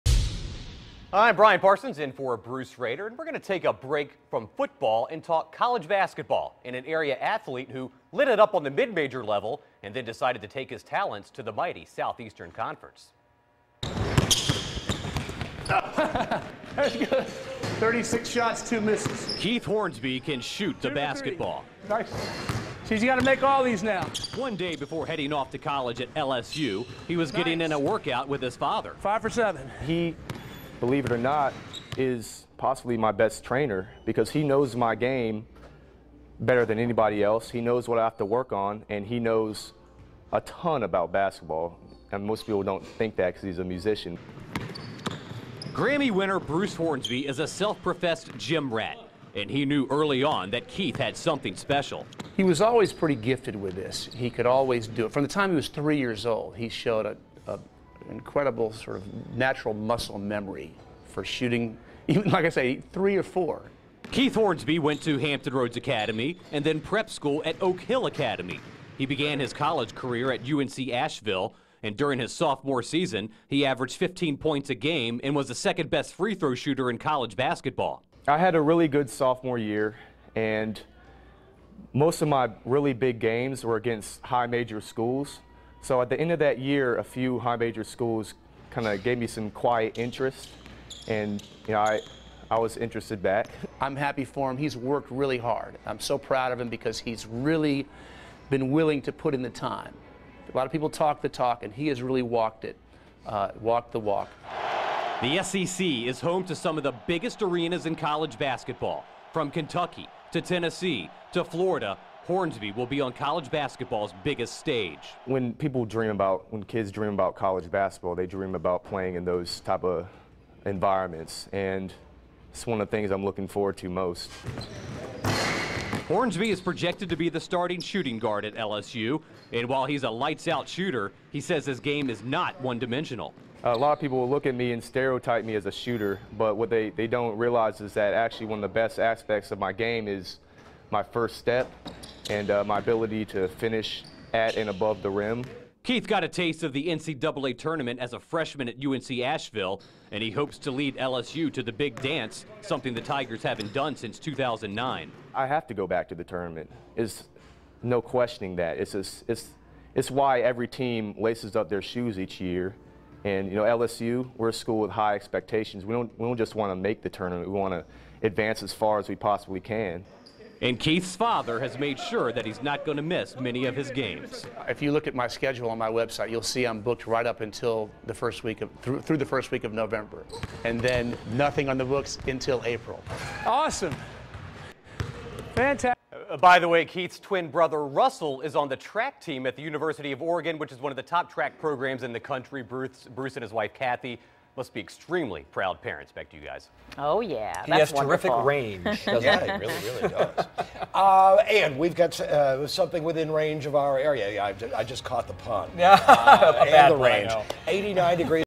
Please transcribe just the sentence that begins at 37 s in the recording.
He knows what I have to work on, and he knows a ton about basketball.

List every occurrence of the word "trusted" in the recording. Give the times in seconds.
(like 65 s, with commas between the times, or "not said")
not said.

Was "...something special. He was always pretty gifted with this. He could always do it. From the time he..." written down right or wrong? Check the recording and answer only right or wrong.
right.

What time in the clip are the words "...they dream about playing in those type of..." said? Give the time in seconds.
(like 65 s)
118 s.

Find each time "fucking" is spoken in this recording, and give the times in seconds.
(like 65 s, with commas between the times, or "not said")
not said.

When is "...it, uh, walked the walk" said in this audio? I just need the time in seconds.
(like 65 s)
102 s.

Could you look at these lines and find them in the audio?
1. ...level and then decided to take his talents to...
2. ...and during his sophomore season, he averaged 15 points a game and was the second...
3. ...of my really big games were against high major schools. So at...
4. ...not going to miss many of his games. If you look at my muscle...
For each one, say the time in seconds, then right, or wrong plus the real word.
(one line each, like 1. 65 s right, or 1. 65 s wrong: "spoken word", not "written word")
1. 9 s right
2. 71 s right
3. 82 s right
4. 172 s wrong: "schedule", not "muscle".